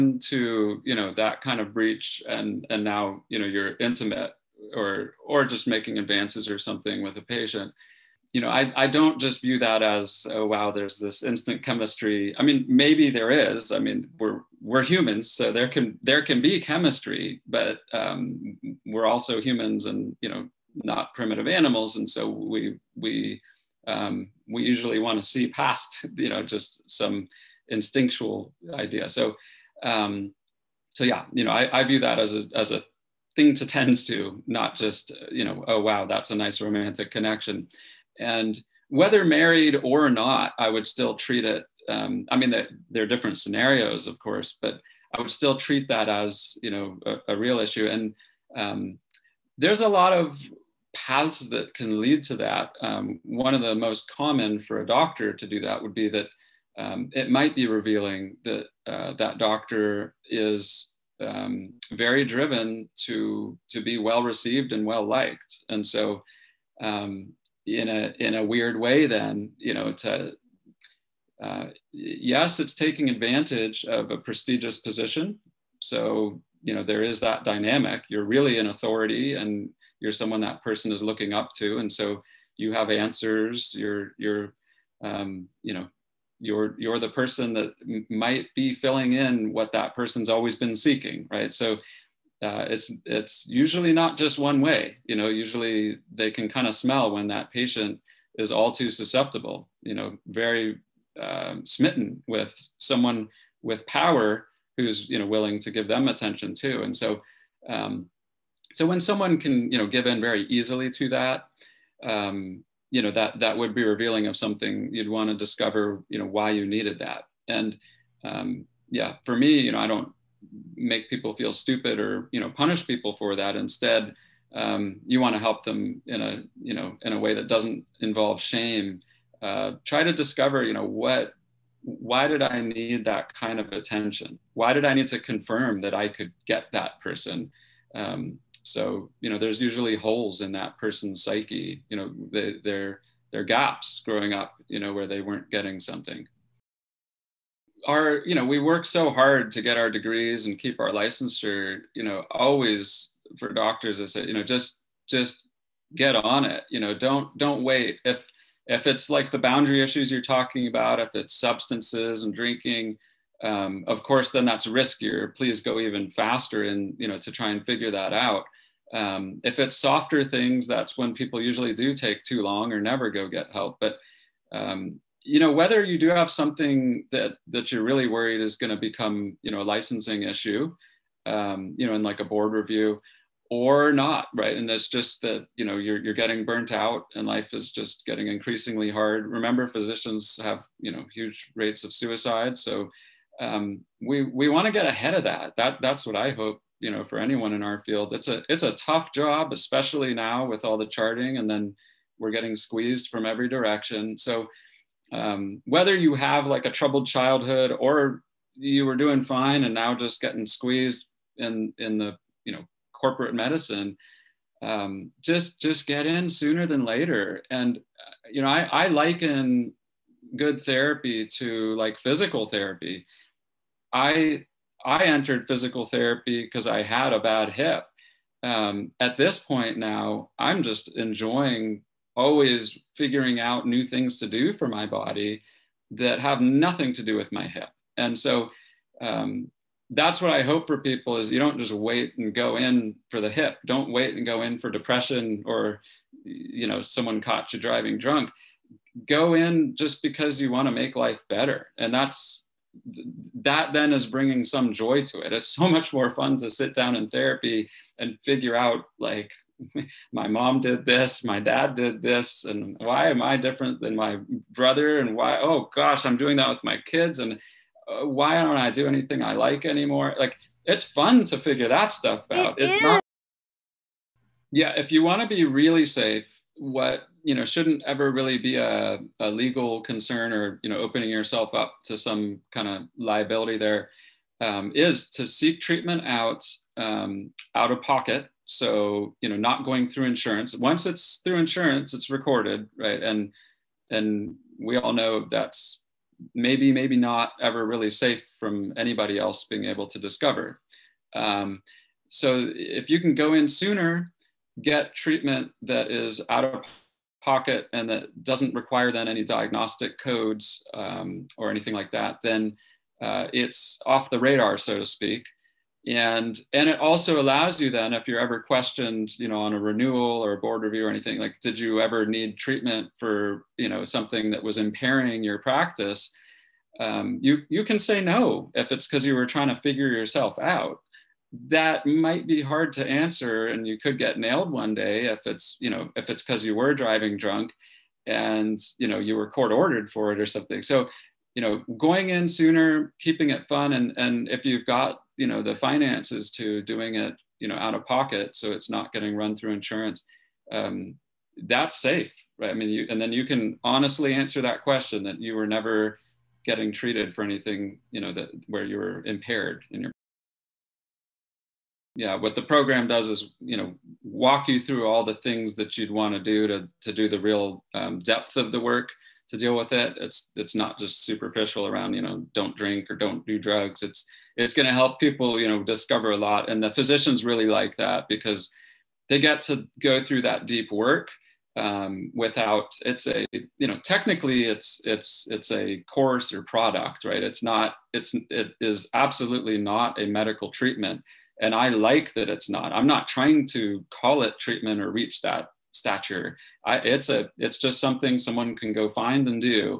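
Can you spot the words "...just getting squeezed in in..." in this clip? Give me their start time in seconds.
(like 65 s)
209 s.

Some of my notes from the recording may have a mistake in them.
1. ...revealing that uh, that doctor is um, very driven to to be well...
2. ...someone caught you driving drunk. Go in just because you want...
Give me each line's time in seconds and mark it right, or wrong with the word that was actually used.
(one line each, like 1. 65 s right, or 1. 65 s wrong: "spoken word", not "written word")
1. 57 s right
2. 246 s right.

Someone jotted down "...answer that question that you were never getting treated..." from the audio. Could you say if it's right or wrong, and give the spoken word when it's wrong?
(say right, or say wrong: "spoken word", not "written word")
right.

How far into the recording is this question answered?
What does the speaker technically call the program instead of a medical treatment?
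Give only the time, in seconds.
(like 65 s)
385 s.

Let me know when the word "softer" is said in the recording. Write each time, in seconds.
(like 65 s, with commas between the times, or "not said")
169 s.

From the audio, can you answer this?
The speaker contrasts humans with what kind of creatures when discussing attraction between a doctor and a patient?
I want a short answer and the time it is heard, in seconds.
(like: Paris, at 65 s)
primitive animals, at 21 s.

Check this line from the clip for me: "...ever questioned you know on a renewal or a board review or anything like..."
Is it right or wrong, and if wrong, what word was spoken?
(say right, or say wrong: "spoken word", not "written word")
right.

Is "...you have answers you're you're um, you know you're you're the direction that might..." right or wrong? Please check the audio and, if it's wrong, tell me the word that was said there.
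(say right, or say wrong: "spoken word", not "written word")
wrong: "person", not "direction".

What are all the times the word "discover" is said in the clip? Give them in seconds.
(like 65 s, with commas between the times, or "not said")
115 s, 130 s, 299 s, 375 s.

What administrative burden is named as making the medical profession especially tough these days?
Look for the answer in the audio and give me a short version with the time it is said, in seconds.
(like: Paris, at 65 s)
charting, at 200 s.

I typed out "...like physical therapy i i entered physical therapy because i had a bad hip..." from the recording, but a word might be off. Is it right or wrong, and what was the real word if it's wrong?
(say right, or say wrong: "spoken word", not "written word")
right.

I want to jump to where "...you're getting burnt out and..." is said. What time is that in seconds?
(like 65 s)
186 s.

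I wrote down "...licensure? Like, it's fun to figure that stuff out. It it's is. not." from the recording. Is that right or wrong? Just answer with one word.
wrong.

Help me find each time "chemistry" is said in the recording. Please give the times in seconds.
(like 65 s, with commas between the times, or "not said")
11 s, 16 s.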